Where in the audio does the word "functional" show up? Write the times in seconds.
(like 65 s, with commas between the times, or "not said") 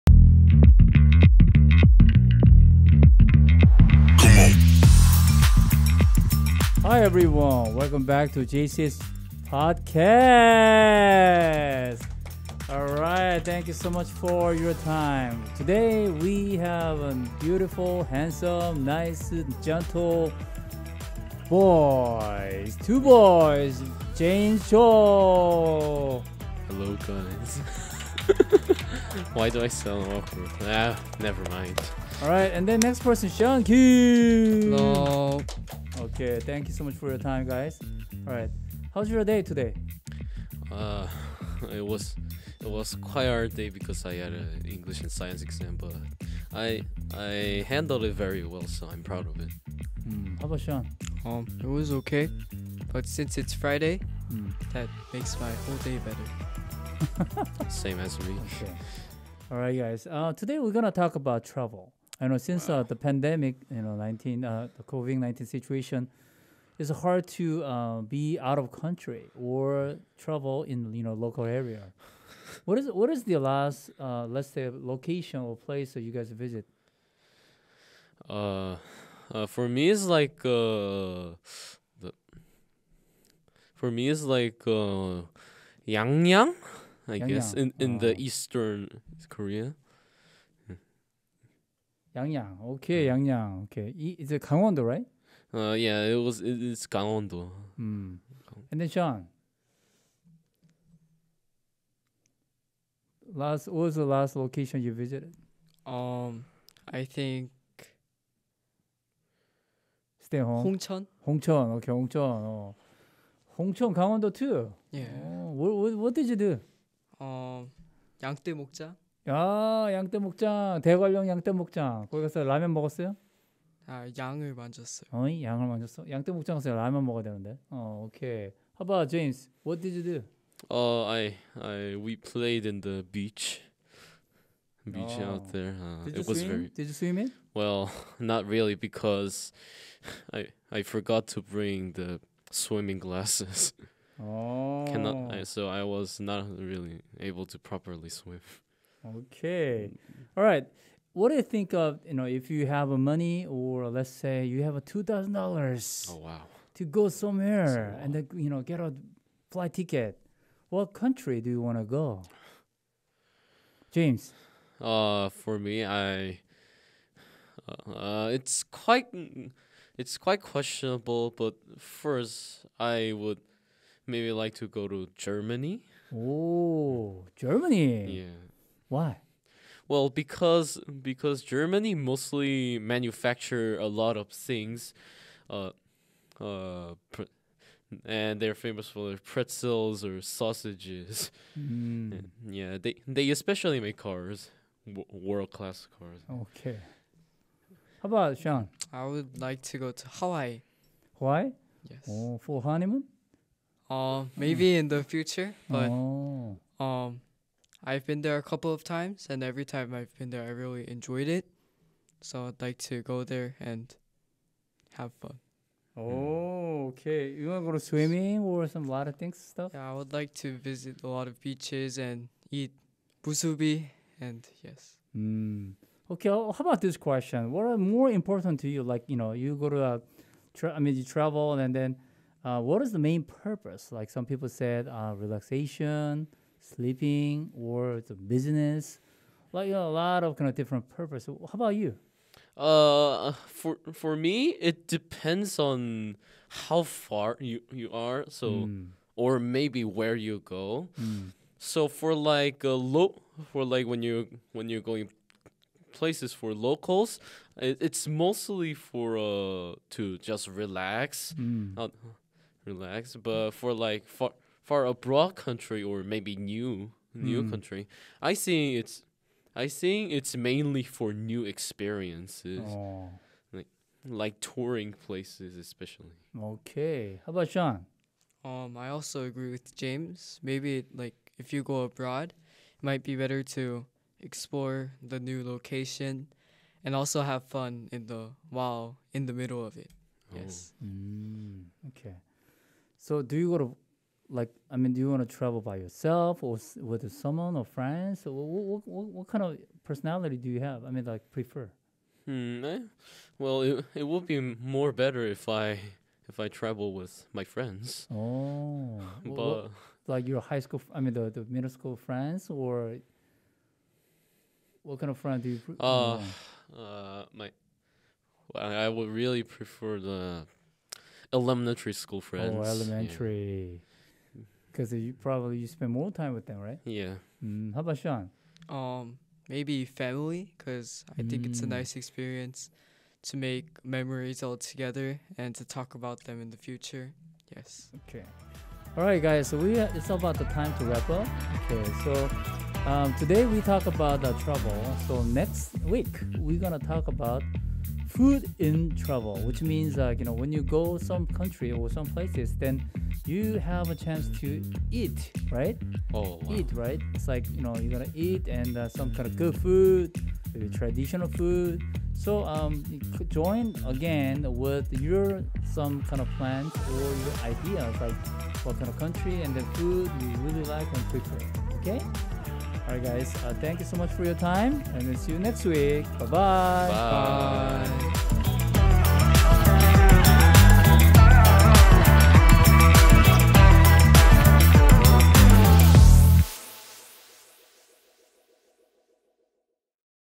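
not said.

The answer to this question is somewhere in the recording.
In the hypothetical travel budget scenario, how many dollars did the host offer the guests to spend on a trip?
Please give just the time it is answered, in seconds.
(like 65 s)
154 s.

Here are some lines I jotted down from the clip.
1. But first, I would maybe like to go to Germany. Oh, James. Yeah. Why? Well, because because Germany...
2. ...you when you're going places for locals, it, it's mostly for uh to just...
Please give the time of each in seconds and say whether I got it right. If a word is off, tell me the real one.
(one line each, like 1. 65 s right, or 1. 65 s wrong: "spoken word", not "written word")
1. 171 s wrong: "Germany", not "James"
2. 254 s right.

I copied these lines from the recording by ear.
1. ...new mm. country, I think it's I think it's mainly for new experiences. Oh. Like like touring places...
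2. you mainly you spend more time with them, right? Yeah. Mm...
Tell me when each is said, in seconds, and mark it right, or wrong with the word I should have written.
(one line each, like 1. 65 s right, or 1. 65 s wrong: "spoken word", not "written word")
1. 267 s right
2. 324 s wrong: "probably", not "mainly".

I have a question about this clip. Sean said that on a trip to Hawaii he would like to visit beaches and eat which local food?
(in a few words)
musubi.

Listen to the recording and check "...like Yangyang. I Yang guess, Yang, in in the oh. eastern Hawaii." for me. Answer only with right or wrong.
wrong.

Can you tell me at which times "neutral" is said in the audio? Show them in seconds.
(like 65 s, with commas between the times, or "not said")
not said.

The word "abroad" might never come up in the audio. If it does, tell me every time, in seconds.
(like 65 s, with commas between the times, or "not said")
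264 s, 281 s.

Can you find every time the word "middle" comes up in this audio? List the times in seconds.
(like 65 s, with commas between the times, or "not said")
289 s, 311 s.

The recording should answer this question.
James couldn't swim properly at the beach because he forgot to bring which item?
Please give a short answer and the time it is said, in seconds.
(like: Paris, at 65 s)
swimming glasses, at 142 s.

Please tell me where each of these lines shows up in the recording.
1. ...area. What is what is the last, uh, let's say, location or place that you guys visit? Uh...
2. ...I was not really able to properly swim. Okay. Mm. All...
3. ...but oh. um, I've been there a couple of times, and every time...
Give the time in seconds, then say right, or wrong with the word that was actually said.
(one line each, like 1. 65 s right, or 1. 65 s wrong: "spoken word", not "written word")
1. 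71 s right
2. 145 s right
3. 205 s right.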